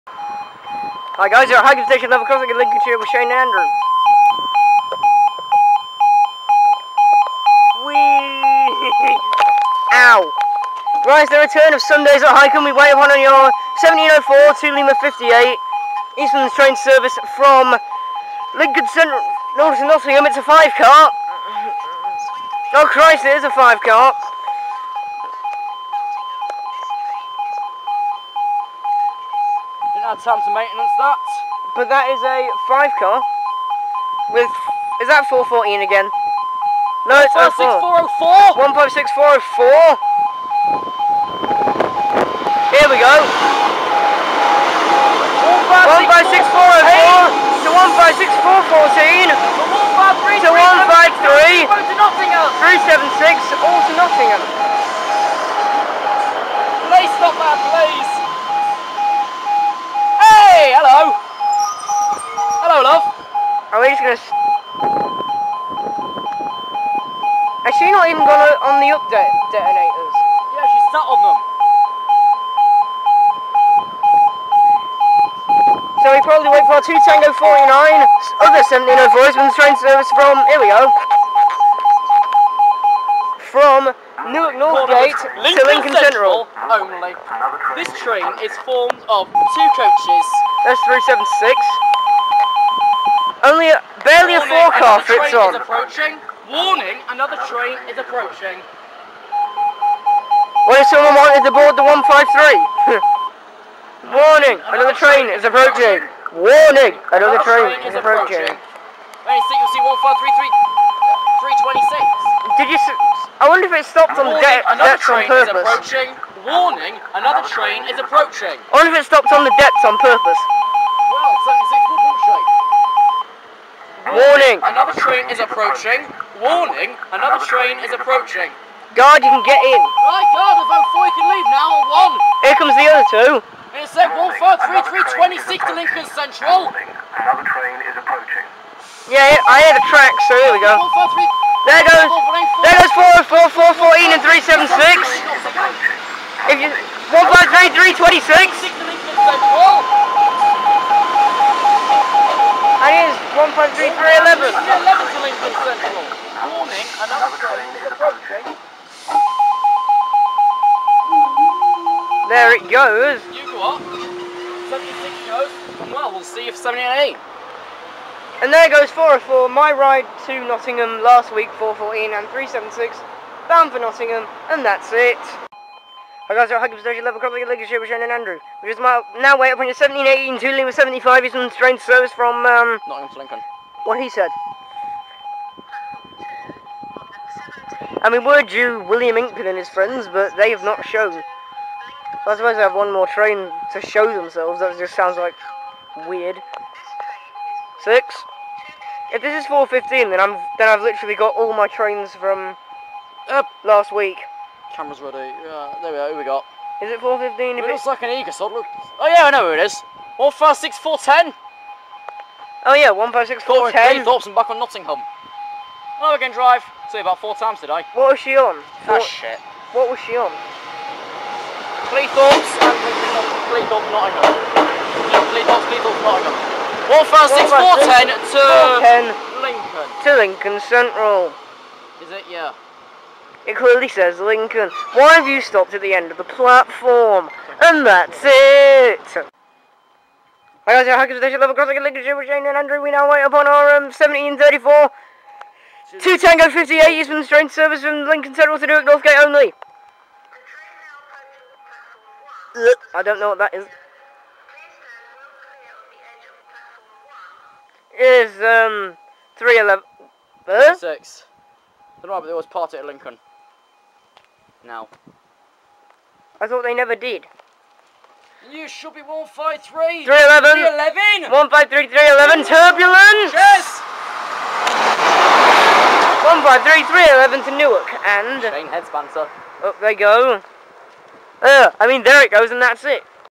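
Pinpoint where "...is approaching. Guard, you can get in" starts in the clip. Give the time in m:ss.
2:07.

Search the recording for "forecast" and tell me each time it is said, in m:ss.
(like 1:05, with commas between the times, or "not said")
1:34.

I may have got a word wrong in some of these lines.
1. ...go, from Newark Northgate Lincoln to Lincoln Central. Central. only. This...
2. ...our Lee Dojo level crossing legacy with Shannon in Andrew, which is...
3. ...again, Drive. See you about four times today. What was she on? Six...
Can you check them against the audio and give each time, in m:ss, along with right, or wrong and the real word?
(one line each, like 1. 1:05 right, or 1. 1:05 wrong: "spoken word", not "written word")
1. 1:20 right
2. 2:56 wrong: "Huggins", not "Lee"
3. 3:36 wrong: "Four", not "Six".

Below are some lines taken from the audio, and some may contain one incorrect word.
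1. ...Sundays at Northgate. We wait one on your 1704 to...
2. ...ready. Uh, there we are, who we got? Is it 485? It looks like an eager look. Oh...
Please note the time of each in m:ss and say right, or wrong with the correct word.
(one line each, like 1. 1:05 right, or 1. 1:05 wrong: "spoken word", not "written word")
1. 0:11 wrong: "Hykeham", not "Northgate"
2. 3:25 wrong: "415", not "485".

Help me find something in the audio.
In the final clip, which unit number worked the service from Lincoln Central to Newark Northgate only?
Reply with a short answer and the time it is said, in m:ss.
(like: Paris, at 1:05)
153311, at 4:36.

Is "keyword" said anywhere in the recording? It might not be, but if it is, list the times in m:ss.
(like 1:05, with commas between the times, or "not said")
not said.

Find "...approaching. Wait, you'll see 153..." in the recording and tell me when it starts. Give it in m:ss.
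1:47.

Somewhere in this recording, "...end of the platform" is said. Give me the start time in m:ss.
3:55.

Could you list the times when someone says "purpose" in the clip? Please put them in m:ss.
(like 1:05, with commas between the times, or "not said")
1:55, 1:59.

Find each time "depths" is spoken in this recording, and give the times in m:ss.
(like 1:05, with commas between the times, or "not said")
1:54, 1:59.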